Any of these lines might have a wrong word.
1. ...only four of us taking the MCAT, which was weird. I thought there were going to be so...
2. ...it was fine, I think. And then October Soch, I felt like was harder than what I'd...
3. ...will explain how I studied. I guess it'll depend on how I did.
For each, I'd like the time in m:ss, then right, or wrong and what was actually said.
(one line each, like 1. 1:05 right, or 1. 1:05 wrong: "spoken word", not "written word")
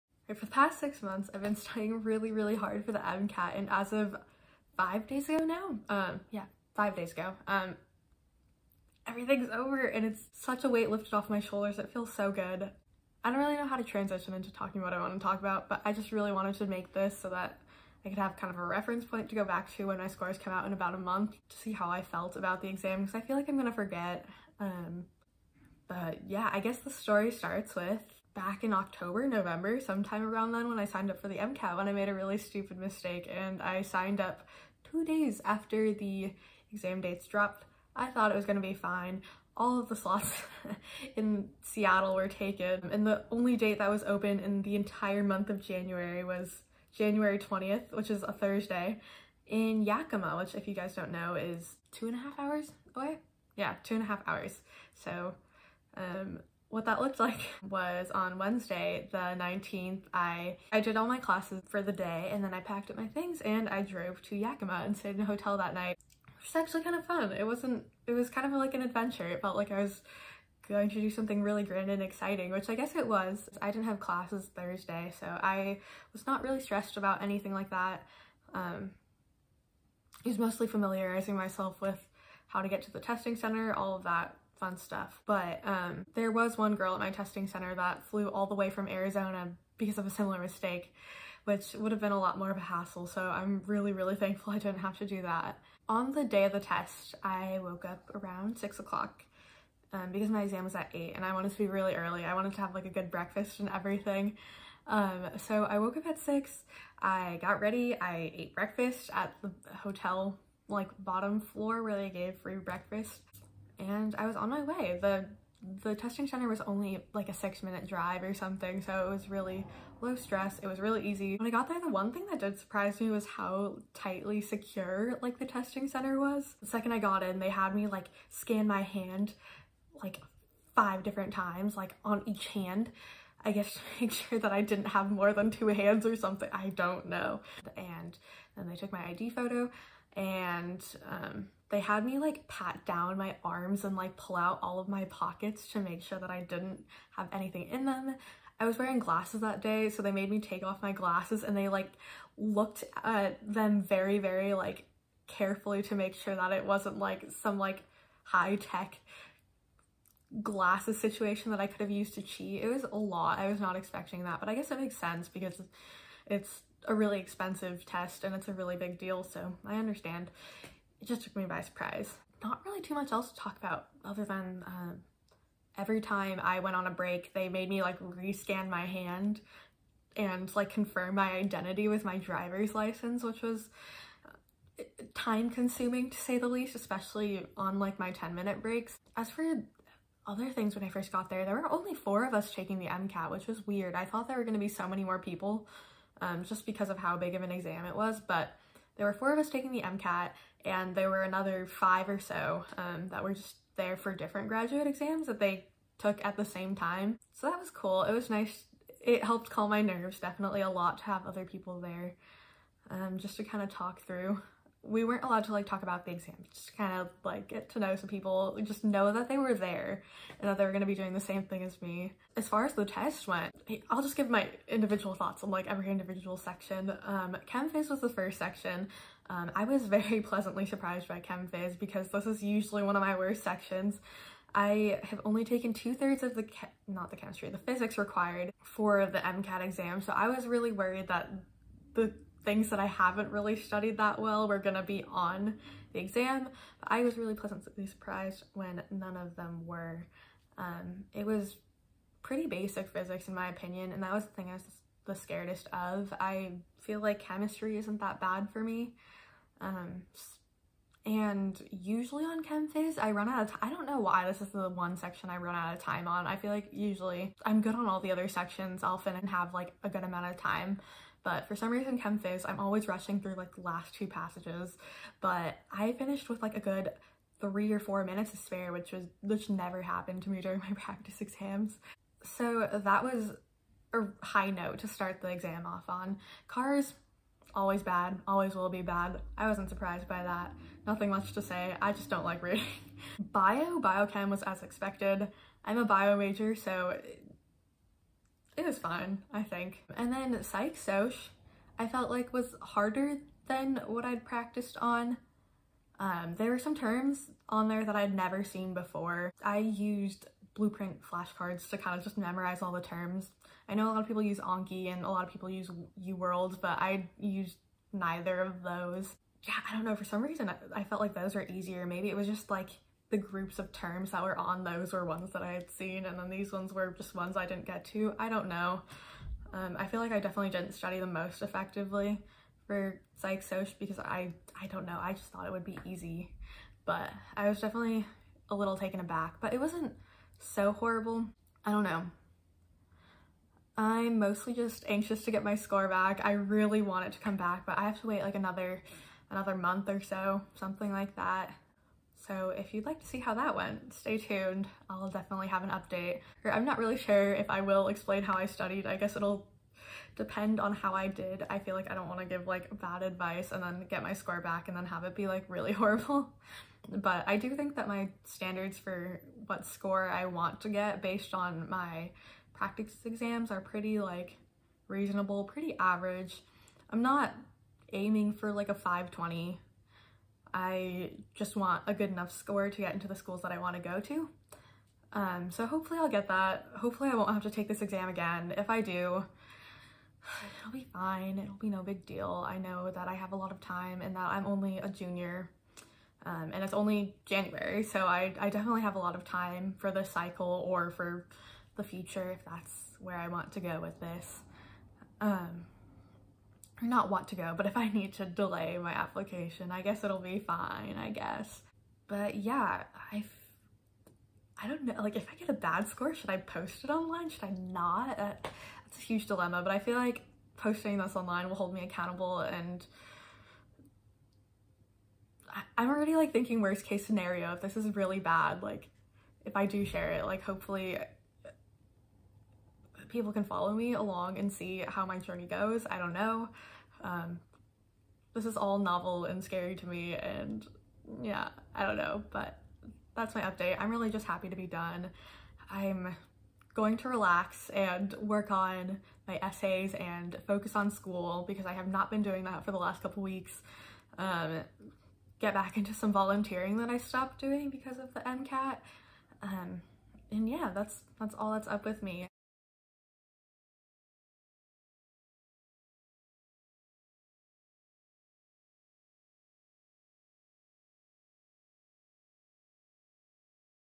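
1. 3:11 right
2. 4:58 wrong: "Psych", not "October"
3. 5:57 right.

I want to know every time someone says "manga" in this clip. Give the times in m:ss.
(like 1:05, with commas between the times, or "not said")
not said.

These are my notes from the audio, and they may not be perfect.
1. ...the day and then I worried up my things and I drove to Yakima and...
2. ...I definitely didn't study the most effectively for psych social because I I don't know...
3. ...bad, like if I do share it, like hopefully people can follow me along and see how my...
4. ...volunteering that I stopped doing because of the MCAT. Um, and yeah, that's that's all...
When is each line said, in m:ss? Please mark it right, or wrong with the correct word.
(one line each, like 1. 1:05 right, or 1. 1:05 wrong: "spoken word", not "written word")
1. 1:01 wrong: "packed", not "worried"
2. 5:30 right
3. 7:08 right
4. 7:36 right.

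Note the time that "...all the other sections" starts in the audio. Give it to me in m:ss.
4:27.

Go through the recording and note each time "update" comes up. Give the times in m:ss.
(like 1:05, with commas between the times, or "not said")
5:55, 7:23.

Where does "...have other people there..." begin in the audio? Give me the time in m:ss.
3:31.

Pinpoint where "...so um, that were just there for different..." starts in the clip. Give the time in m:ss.
3:22.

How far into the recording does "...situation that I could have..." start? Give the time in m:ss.
2:40.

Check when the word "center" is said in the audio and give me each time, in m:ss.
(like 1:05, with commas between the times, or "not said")
1:23, 1:27, 1:56, 2:05.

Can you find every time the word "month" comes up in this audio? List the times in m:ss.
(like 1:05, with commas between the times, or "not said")
0:01, 0:20, 0:45, 5:49.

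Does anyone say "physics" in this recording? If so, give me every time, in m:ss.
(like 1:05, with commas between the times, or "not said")
3:57, 4:12.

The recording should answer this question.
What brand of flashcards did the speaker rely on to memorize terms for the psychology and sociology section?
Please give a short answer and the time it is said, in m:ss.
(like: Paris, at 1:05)
Blueprint, at 5:10.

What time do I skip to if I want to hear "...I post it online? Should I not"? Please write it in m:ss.
6:56.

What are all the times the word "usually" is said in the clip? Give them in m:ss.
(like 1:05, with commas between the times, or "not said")
3:52, 4:21, 4:26.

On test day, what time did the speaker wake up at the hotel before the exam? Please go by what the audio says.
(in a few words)
6.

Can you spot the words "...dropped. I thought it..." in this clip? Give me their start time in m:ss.
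0:37.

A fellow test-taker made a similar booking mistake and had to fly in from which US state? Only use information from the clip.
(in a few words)
Arizona.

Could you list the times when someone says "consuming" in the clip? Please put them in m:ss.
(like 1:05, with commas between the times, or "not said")
3:05.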